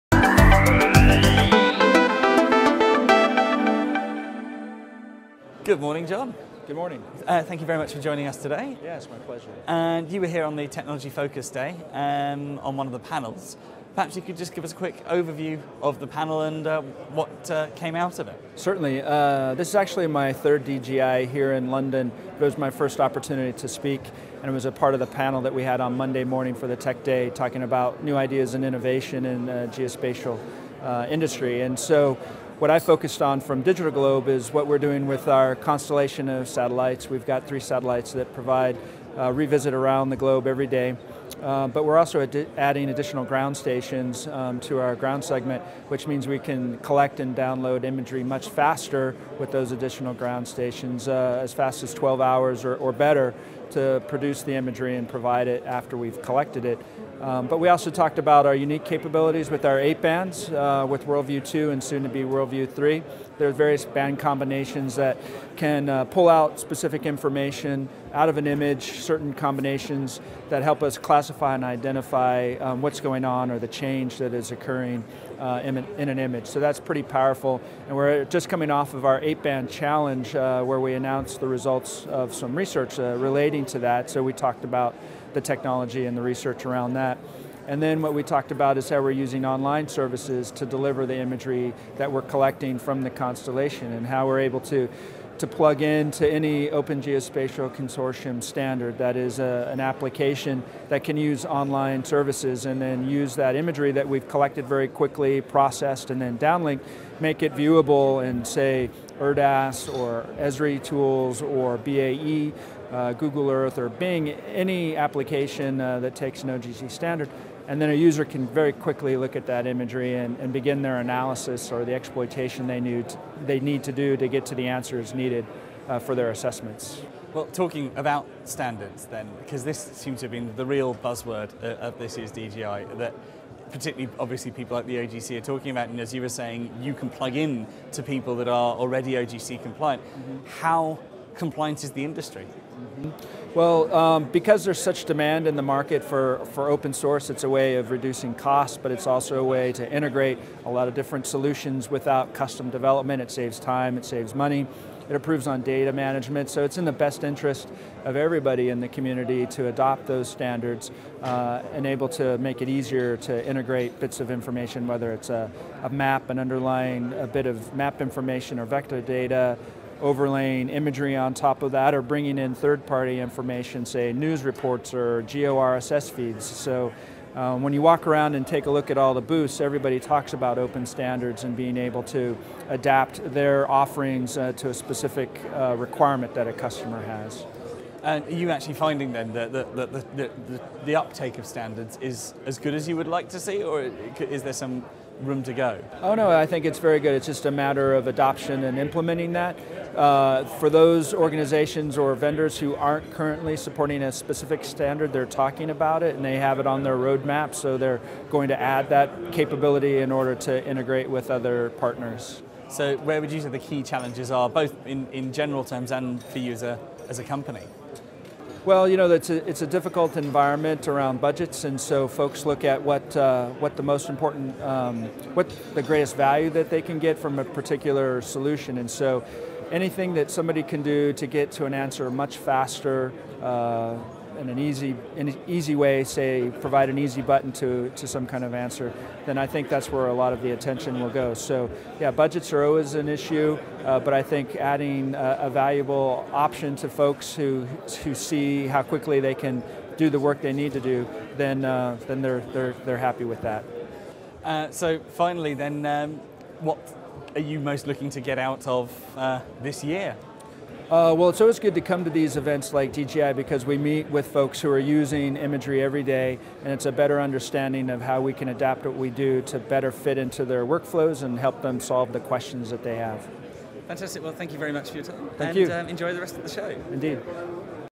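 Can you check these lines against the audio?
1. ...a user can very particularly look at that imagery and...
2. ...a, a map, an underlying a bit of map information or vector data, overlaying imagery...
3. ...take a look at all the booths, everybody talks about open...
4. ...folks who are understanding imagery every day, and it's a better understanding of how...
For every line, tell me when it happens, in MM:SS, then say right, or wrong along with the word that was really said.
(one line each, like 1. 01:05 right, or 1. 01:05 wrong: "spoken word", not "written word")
1. 01:57 wrong: "quickly", not "particularly"
2. 02:45 right
3. 02:58 right
4. 04:24 wrong: "using", not "understanding".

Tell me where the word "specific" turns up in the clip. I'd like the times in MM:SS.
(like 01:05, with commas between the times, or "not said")
01:06, 03:04, 03:24.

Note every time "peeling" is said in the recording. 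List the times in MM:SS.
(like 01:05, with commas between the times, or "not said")
not said.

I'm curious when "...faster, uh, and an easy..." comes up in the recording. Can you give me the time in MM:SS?
03:52.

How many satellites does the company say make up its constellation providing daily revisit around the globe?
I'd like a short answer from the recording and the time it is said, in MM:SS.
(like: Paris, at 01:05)
3, at 00:37.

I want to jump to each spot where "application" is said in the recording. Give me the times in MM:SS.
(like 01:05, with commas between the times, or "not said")
01:39, 01:54.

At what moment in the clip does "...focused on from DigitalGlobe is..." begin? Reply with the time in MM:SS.
00:32.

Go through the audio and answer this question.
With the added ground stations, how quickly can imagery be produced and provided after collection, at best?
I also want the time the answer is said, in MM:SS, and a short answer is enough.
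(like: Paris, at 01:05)
12 hours, at 00:51.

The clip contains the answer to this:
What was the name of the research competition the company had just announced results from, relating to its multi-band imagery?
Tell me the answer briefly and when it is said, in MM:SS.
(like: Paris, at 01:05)
eight band challenge, at 01:19.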